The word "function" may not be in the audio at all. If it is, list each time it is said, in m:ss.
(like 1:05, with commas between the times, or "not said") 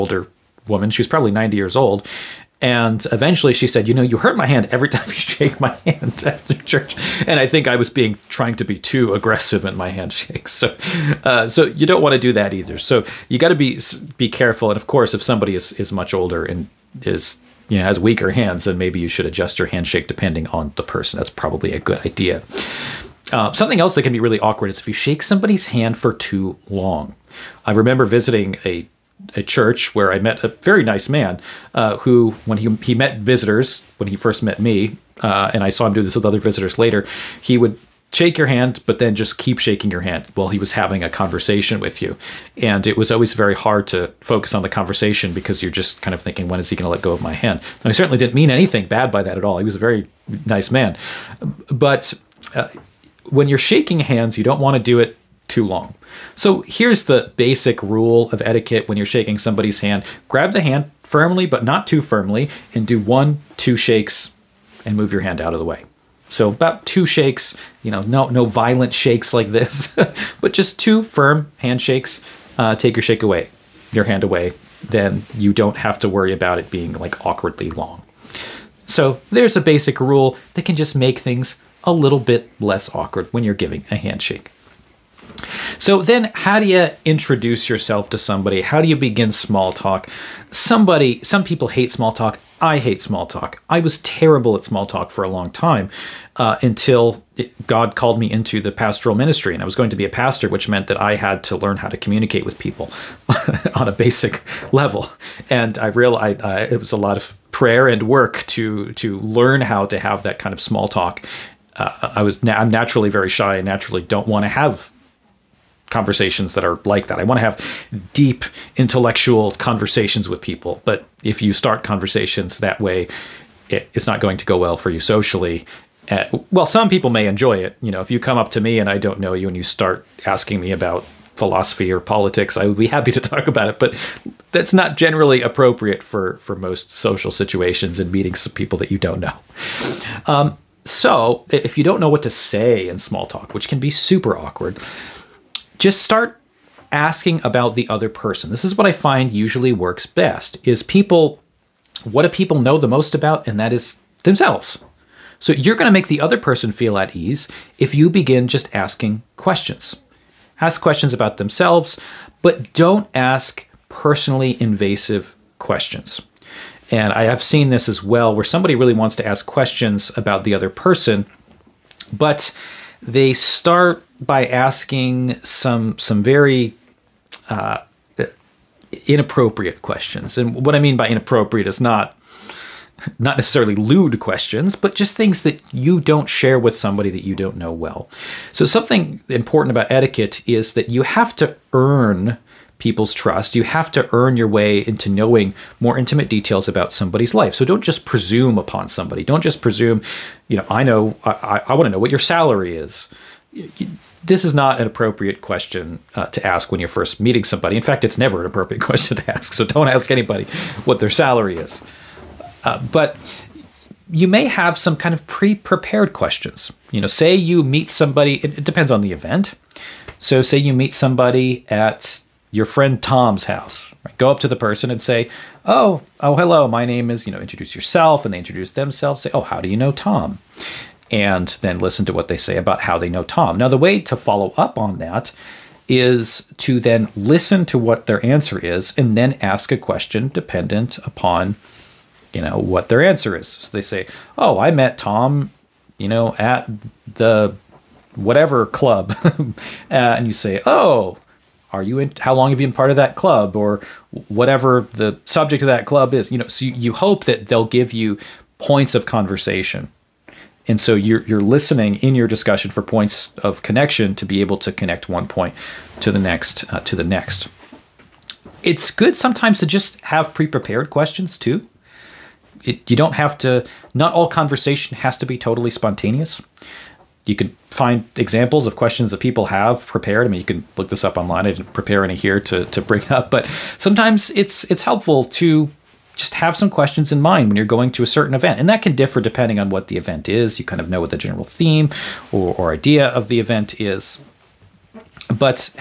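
not said.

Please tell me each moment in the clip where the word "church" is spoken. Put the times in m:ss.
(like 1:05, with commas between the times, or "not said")
0:06, 0:29.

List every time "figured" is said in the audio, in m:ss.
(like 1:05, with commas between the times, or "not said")
not said.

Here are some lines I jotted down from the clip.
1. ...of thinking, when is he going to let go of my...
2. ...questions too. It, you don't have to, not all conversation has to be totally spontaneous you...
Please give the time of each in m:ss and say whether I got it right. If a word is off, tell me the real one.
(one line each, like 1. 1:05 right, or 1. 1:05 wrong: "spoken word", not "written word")
1. 0:46 right
2. 4:30 right.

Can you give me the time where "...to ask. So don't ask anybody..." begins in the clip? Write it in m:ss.
3:29.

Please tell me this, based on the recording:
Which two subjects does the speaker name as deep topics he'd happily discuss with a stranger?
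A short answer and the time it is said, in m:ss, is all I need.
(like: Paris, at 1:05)
philosophy or politics, at 2:11.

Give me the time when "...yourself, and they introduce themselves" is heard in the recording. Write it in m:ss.
3:47.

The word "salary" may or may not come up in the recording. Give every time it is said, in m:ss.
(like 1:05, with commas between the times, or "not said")
3:22, 3:31.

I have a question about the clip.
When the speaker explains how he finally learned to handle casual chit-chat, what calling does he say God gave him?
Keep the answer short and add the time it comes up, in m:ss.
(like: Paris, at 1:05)
pastoral ministry, at 1:38.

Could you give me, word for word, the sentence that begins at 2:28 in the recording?
This is what I find usually works best is people what do people know the most about and that is themselves.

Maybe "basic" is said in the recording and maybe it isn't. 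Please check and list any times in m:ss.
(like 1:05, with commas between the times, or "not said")
0:57, 1:19, 1:43.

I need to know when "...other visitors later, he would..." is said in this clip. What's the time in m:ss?
0:36.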